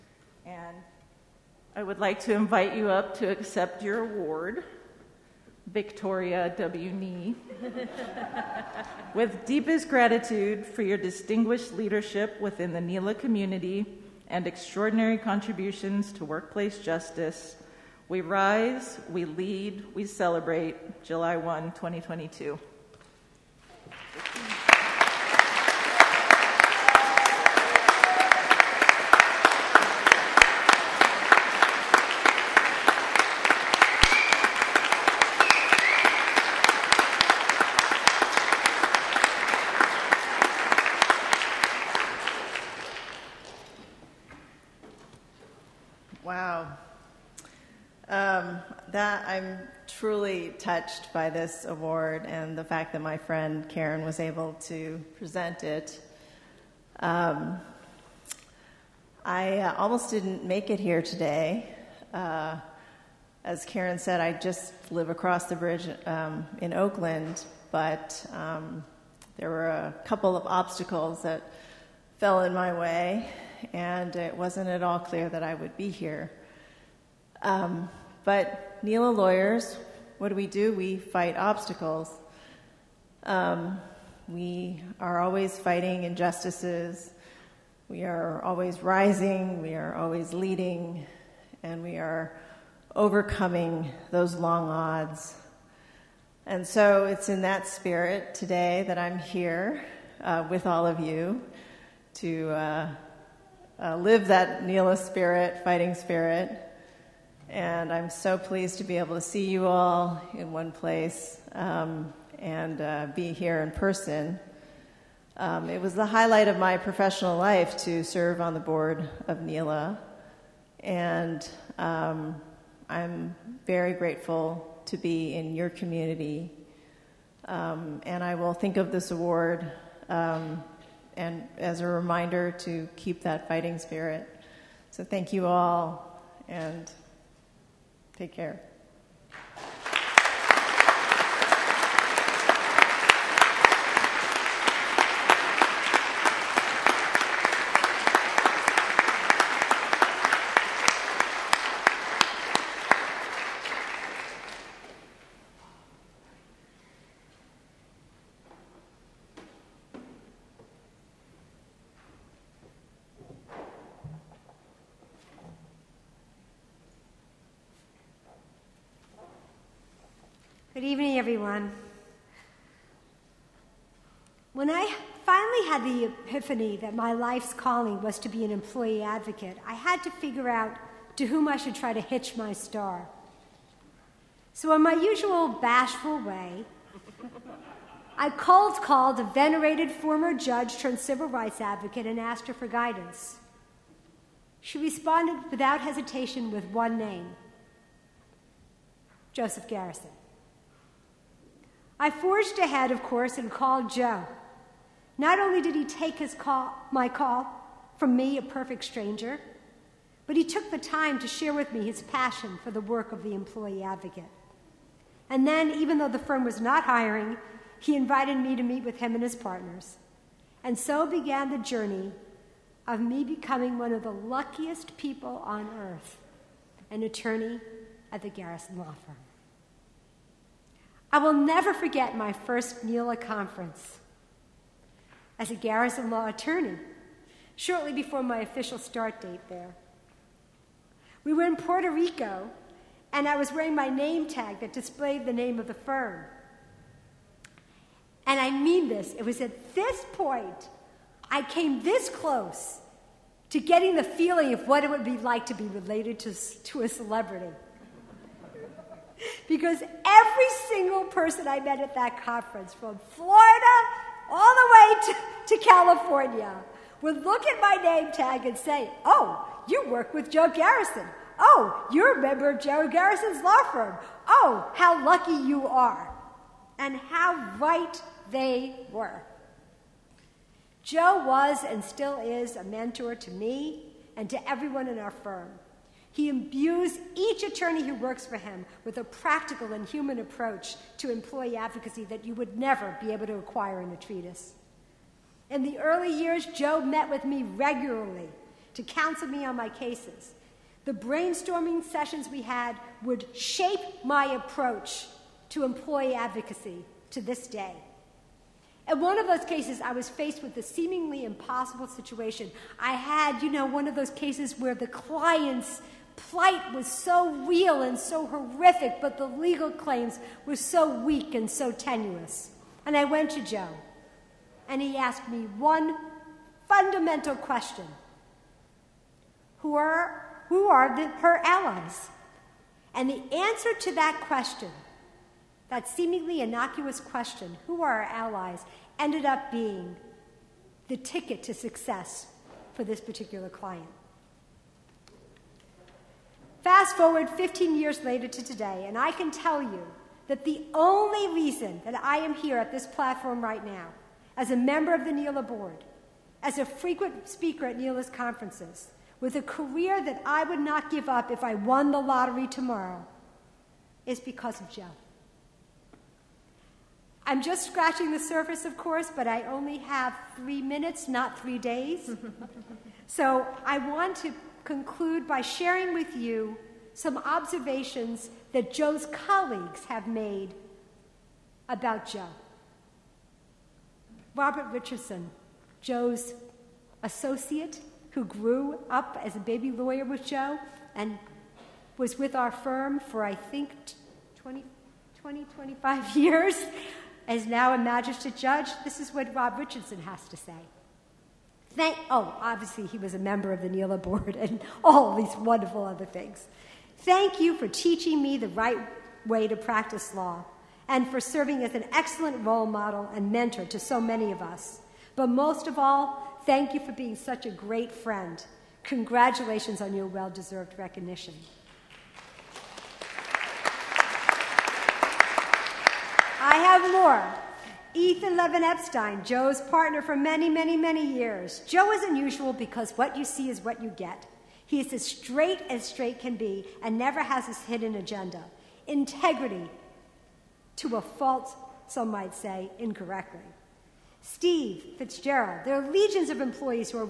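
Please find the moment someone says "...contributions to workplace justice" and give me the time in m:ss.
0:15.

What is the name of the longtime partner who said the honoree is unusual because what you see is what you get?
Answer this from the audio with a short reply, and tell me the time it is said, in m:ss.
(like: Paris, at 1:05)
Ethan Levin Epstein, at 7:07.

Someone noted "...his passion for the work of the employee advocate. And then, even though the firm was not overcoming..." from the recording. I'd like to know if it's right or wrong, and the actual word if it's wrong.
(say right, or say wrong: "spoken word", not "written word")
wrong: "hiring", not "overcoming".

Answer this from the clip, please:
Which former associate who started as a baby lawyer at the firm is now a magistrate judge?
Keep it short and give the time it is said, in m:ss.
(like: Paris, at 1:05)
Robert Richardson, at 6:24.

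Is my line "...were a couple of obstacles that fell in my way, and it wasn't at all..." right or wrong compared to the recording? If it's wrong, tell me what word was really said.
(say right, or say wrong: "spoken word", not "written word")
right.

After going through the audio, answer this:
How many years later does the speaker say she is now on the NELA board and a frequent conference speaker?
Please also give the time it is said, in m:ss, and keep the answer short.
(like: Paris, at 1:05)
15, at 5:47.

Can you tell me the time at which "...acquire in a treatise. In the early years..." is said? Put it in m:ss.
4:53.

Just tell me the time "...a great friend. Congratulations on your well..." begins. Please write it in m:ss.
6:57.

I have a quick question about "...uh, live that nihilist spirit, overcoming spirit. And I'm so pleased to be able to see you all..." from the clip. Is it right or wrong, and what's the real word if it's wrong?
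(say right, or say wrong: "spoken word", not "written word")
wrong: "fighting", not "overcoming".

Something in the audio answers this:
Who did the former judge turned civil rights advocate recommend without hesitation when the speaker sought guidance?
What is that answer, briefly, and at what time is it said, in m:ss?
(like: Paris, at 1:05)
Joseph Garrison, at 3:19.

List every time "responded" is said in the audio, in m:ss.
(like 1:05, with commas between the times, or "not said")
3:14.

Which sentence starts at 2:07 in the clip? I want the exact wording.
Um, and I will think of this award um, and as a reminder to keep that fighting spirit.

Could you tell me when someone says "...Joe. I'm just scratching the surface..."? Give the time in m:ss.
6:04.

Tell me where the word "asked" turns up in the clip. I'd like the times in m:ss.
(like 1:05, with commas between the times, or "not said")
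3:12, 5:24.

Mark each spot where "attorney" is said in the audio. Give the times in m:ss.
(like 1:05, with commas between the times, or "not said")
3:47, 3:56, 4:47.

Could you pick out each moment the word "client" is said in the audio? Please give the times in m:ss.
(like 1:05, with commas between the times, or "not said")
5:14, 5:43.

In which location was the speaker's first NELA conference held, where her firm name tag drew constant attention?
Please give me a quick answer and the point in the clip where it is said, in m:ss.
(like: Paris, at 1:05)
Puerto Rico, at 4:01.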